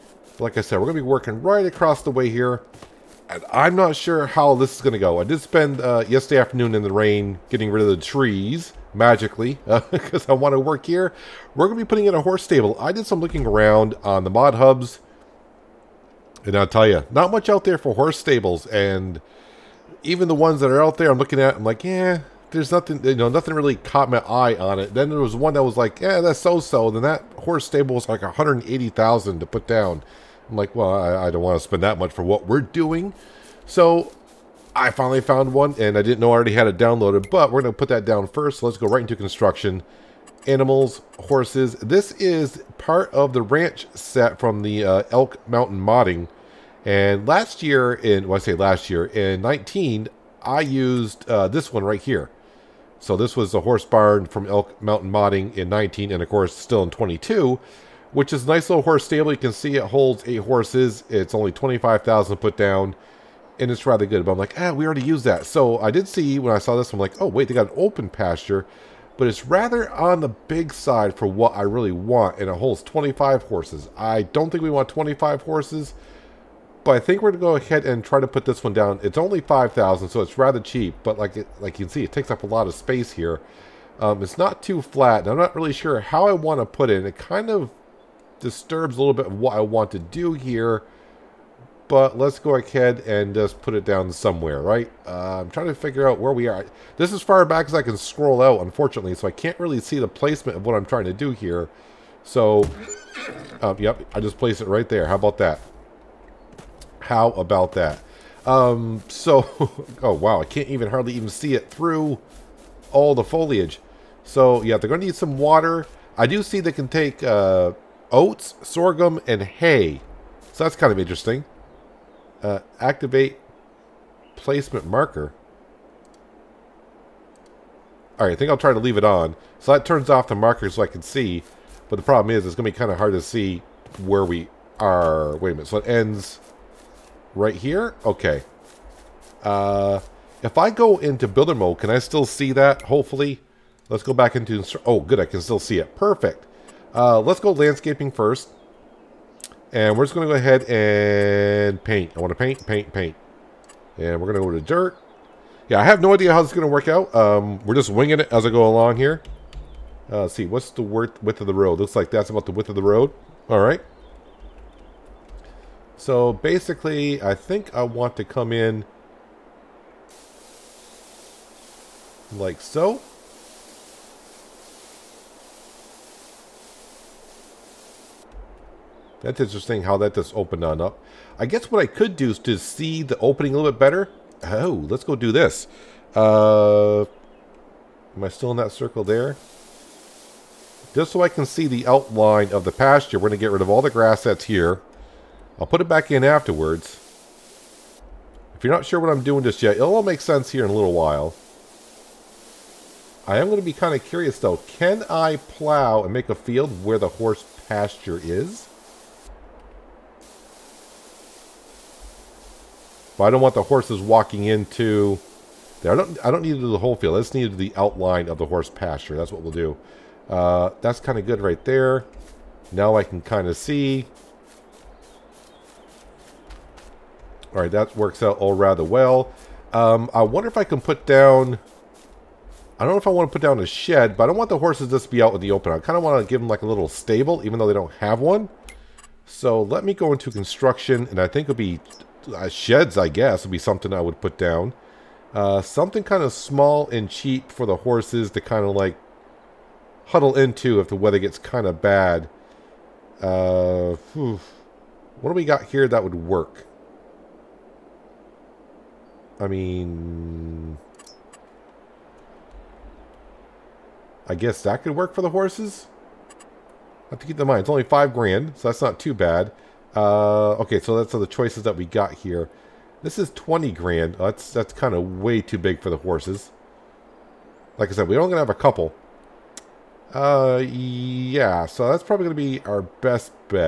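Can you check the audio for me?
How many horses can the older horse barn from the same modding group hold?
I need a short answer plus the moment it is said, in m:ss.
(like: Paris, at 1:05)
8, at 1:00.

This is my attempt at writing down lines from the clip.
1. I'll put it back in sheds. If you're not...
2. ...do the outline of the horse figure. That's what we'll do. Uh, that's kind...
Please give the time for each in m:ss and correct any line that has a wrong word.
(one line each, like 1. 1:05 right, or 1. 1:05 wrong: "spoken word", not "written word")
1. 3:15 wrong: "afterwards", not "sheds"
2. 3:37 wrong: "pasture", not "figure".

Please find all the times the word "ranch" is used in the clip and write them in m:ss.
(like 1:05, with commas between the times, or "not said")
0:43.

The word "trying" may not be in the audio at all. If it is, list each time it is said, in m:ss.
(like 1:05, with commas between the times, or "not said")
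1:35, 1:40.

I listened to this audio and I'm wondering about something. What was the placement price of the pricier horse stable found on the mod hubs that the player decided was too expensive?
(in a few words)
180,000.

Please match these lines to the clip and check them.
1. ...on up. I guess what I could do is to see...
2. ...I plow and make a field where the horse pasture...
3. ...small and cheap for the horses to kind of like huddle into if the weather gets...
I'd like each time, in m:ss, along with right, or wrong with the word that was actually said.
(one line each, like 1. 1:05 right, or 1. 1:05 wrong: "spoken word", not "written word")
1. 3:00 right
2. 3:25 right
3. 4:06 right.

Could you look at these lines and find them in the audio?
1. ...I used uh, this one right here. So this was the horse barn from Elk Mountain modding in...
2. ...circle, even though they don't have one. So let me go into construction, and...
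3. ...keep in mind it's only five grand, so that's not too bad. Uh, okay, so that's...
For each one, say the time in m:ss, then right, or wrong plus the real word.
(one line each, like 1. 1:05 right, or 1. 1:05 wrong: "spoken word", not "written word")
1. 0:50 right
2. 3:56 wrong: "stable", not "circle"
3. 4:27 right.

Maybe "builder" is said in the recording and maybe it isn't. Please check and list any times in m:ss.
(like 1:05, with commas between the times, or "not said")
2:21.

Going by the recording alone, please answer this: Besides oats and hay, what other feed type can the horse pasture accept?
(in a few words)
Sorghum.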